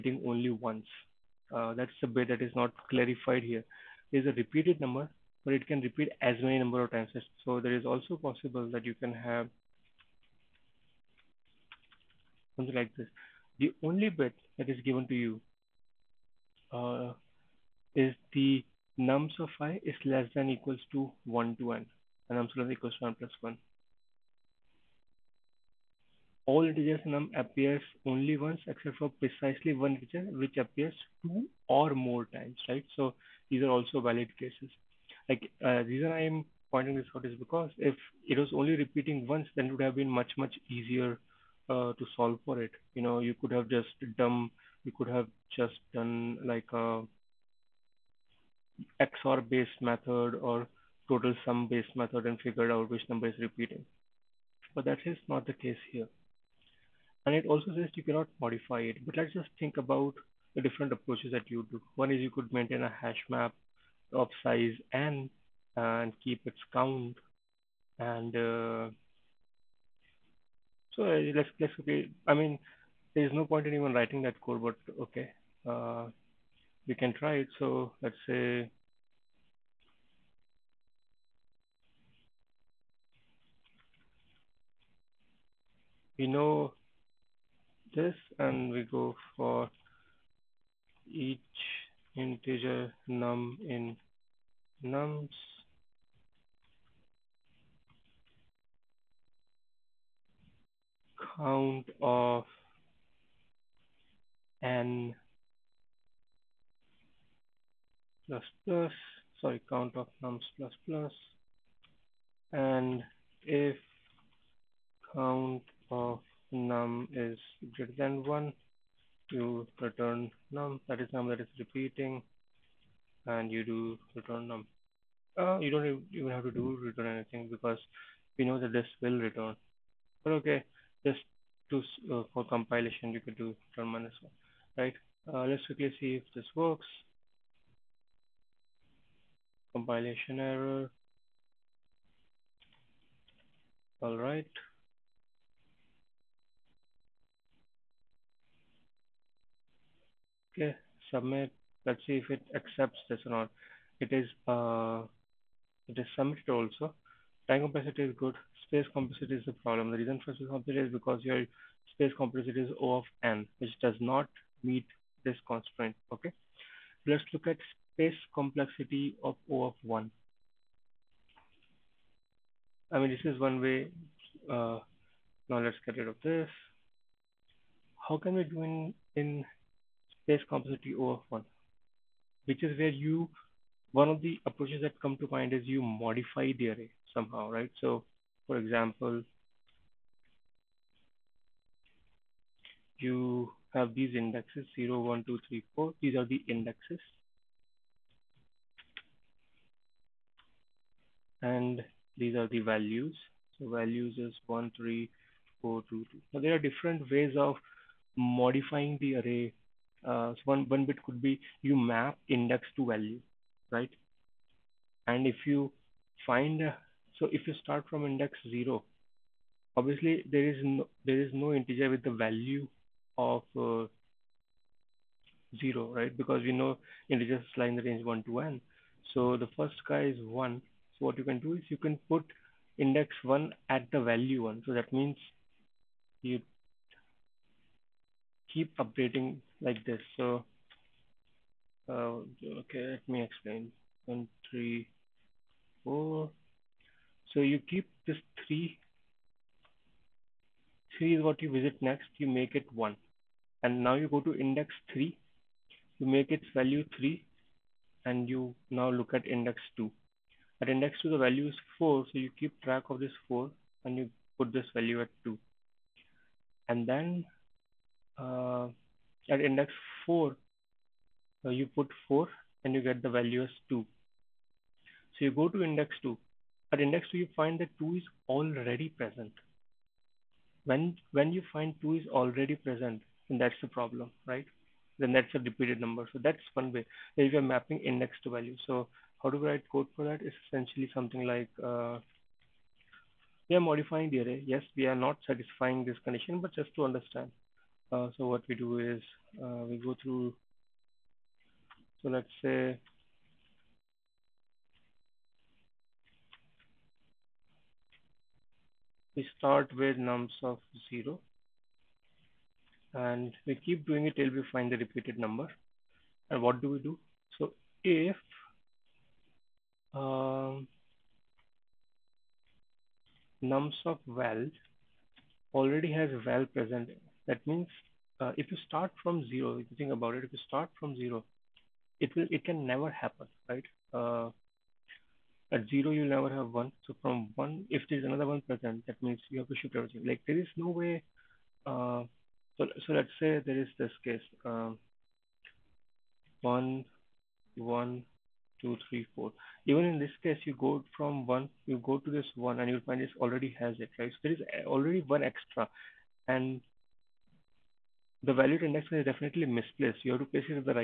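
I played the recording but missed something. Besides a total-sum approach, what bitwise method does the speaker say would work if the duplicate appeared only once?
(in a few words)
XOR based method.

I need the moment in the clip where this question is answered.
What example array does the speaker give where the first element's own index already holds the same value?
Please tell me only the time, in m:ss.
5:46.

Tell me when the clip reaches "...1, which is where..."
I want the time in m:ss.
3:01.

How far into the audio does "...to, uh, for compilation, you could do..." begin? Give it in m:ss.
2:11.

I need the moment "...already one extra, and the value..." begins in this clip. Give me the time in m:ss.
5:54.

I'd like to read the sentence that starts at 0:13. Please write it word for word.
The only bit that is given to you uh, is the nums of i is less than equals to 1 to n.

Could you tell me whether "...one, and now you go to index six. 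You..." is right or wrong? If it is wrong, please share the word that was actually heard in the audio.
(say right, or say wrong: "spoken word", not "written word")
wrong: "three", not "six".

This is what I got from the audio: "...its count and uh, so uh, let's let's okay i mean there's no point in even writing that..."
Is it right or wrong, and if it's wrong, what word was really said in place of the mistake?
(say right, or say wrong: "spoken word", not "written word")
right.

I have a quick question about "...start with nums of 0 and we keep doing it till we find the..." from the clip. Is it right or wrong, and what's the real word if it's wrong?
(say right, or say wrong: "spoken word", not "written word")
right.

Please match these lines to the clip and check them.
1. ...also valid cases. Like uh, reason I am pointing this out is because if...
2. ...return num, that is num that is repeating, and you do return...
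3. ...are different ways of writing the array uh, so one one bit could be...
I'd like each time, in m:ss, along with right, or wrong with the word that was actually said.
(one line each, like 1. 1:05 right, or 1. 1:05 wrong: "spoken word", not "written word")
1. 0:33 right
2. 1:59 right
3. 3:26 wrong: "modifying", not "writing".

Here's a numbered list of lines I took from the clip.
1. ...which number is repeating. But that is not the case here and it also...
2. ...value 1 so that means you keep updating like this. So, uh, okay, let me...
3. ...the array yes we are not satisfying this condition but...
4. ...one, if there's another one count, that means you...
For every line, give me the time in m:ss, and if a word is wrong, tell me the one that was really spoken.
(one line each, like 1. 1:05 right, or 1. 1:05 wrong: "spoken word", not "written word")
1. 0:52 right
2. 3:54 right
3. 4:54 right
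4. 5:37 wrong: "present", not "count".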